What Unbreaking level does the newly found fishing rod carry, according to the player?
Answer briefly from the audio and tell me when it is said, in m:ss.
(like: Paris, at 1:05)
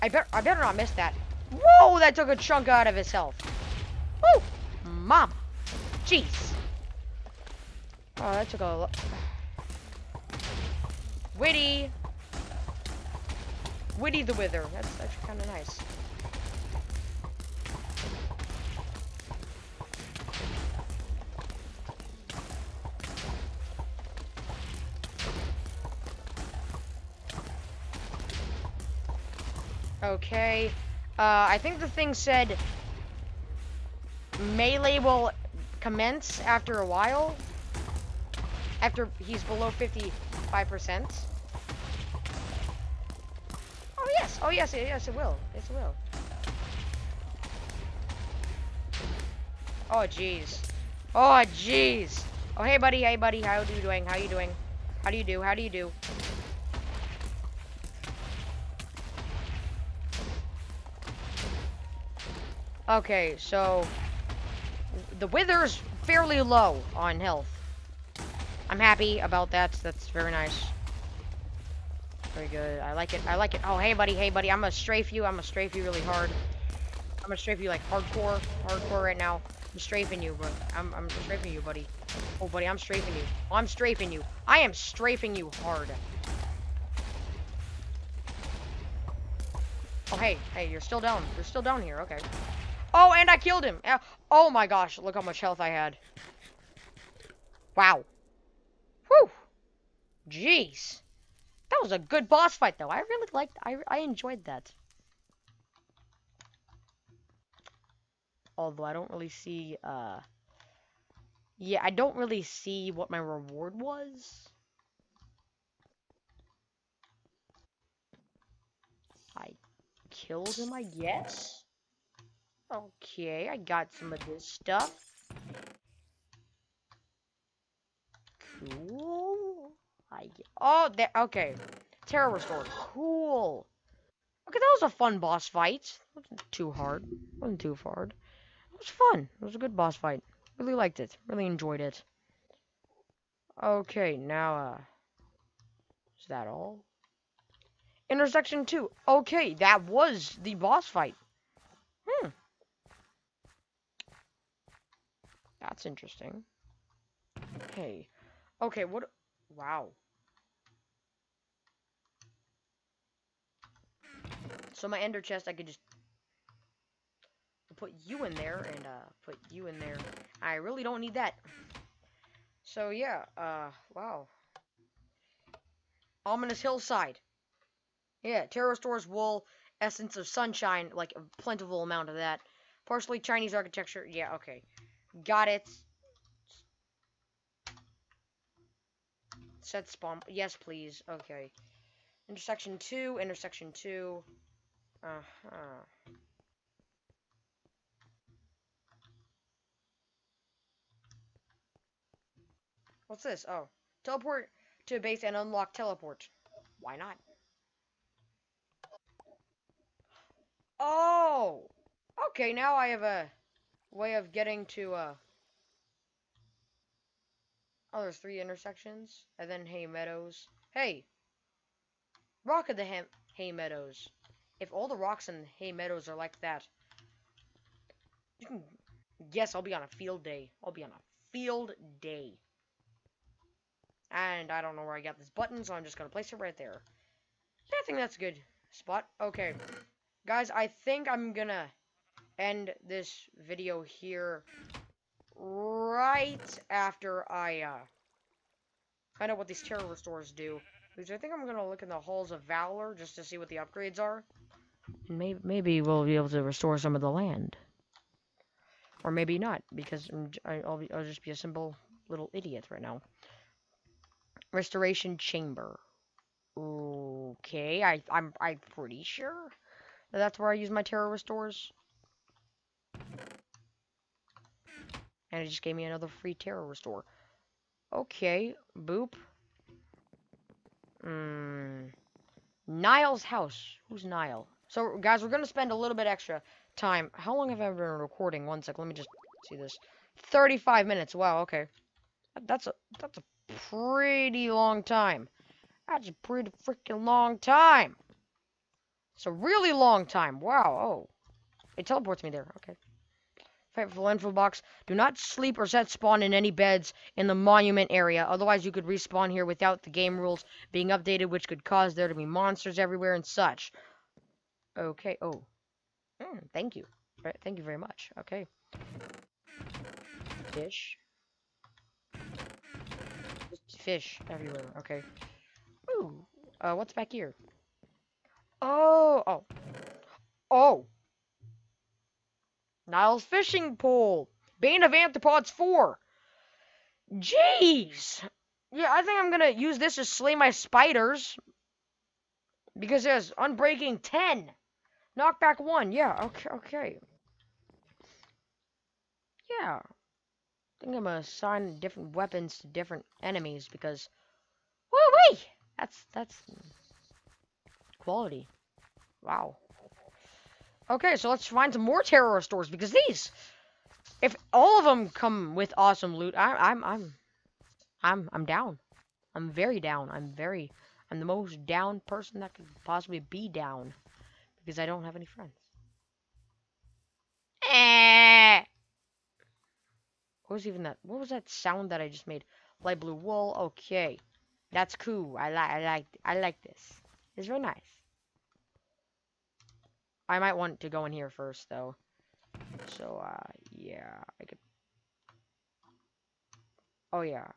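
10, at 5:43.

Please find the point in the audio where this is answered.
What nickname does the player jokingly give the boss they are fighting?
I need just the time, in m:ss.
0:13.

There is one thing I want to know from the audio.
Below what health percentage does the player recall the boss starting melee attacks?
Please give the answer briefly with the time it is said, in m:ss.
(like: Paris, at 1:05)
55%, at 0:39.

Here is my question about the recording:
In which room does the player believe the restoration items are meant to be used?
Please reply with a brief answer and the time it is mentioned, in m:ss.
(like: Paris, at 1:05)
Restoration Chamber, at 4:24.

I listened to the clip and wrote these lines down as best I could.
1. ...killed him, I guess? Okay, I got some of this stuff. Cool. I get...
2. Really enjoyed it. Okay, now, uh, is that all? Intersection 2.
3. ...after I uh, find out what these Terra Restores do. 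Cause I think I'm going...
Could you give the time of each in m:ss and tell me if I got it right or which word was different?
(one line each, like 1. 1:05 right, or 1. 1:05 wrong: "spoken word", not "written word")
1. 2:00 right
2. 2:21 right
3. 4:06 right.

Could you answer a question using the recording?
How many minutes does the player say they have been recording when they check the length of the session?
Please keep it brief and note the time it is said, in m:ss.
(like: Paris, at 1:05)
35, at 4:50.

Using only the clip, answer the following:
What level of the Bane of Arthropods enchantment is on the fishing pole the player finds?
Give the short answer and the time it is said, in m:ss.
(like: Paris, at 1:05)
4, at 5:34.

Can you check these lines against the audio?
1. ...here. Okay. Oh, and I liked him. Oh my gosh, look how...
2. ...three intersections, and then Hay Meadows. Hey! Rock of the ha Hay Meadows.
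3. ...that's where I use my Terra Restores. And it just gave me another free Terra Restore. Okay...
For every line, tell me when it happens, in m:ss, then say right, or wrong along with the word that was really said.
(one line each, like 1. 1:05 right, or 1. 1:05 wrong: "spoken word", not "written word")
1. 1:31 wrong: "killed", not "liked"
2. 3:38 right
3. 4:30 right.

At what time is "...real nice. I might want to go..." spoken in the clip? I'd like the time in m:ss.
6:27.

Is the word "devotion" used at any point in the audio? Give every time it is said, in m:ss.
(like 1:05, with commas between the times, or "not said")
not said.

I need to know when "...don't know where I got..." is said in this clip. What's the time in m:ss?
3:54.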